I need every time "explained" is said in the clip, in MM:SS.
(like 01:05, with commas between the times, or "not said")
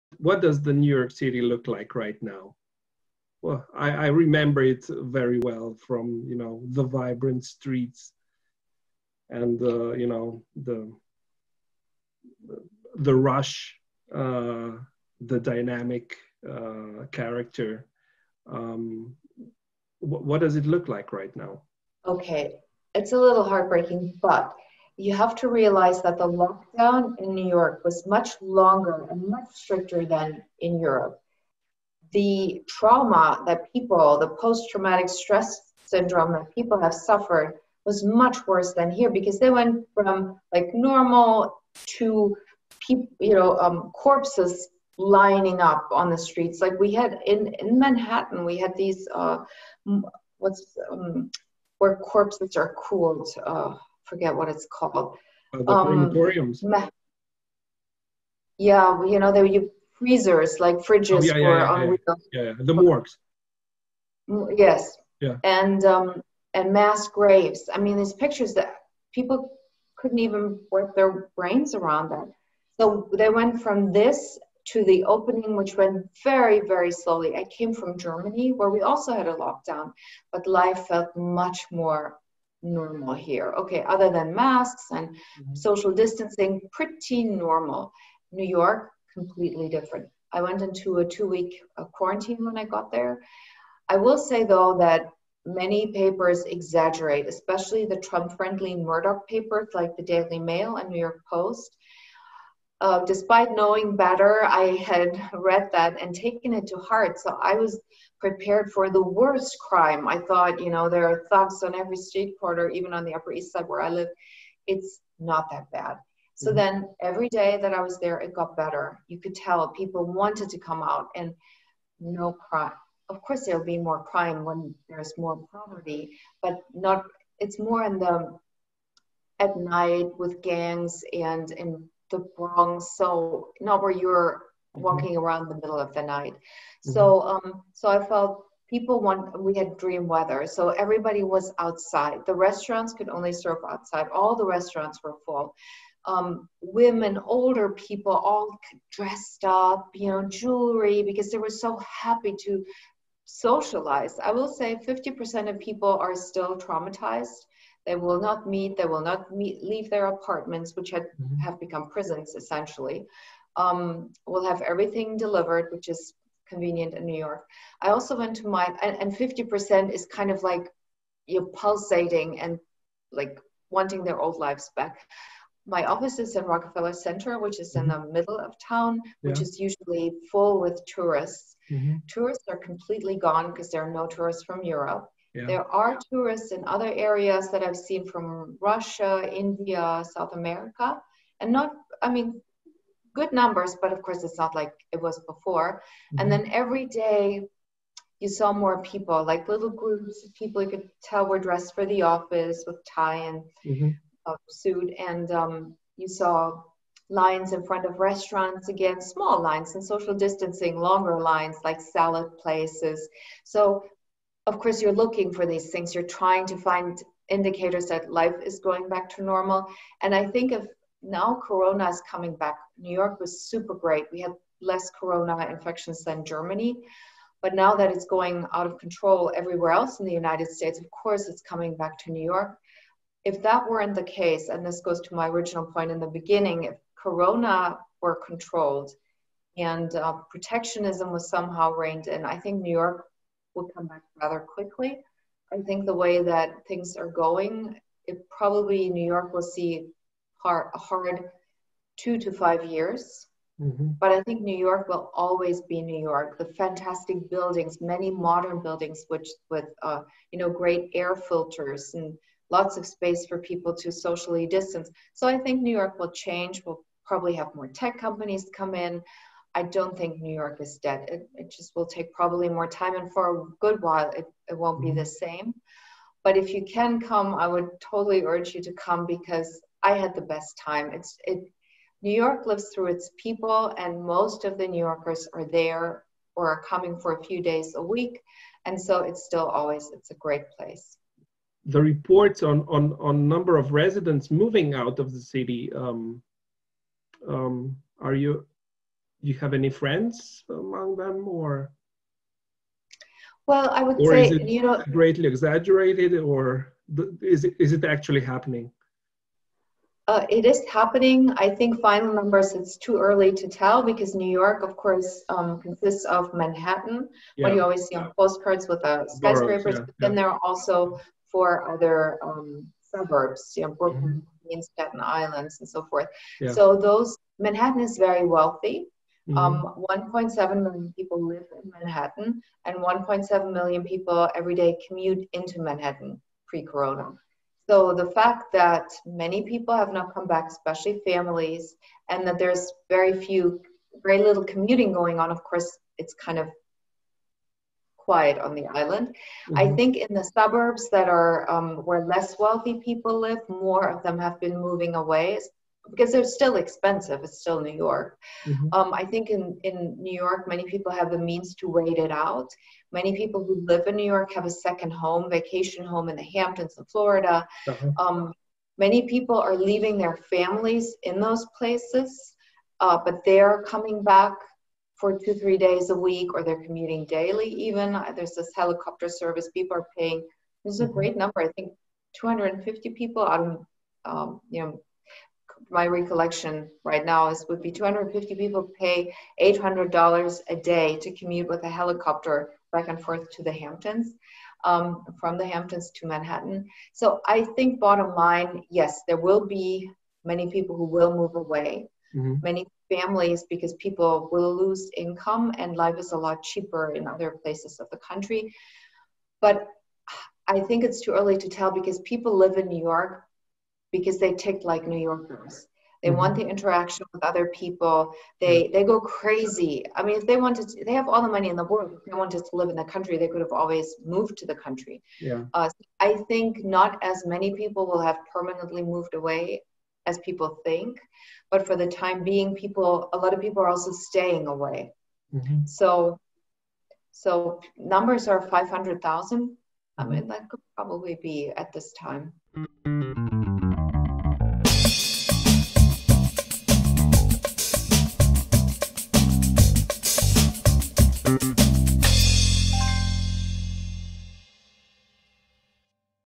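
not said.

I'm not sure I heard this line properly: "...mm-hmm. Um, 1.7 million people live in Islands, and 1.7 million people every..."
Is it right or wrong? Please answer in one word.
wrong.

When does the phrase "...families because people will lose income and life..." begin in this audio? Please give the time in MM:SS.
06:42.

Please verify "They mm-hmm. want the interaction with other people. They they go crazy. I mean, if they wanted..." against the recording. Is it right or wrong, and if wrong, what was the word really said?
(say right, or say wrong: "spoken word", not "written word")
right.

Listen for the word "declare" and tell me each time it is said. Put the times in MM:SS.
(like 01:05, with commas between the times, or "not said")
not said.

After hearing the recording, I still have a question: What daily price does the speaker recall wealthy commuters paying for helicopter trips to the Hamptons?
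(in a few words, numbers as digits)
$800.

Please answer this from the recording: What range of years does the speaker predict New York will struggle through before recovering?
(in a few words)
2 to 5 years.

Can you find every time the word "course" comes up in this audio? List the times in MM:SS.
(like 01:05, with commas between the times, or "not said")
02:03, 03:14, 03:34, 03:50, 05:14, 05:45.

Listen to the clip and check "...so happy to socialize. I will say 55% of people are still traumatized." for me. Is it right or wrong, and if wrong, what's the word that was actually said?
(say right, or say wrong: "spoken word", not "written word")
wrong: "50", not "55".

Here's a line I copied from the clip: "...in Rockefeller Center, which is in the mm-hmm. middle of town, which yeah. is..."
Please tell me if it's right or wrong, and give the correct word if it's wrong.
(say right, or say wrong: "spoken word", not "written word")
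right.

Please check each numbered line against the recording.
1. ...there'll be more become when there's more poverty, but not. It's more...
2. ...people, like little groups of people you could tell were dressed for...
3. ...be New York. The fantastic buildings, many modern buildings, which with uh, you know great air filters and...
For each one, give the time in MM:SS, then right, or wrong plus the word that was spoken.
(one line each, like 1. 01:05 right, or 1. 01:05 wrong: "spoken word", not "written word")
1. 02:03 wrong: "crime", not "become"
2. 03:18 right
3. 04:15 right.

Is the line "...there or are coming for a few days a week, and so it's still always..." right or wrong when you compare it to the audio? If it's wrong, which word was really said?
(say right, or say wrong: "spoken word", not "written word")
right.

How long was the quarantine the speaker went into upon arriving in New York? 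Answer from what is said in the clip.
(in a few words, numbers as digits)
two week.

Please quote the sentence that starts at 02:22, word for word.
The restaurants could only serve outside.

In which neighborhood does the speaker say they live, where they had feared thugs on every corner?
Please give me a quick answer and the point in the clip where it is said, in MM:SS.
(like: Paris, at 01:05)
Upper East Side, at 01:53.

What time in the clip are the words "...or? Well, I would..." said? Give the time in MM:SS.
05:01.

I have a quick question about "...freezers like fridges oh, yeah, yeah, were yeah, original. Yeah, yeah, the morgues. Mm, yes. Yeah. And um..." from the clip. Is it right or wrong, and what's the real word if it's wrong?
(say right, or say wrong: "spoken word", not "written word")
wrong: "unreal", not "original".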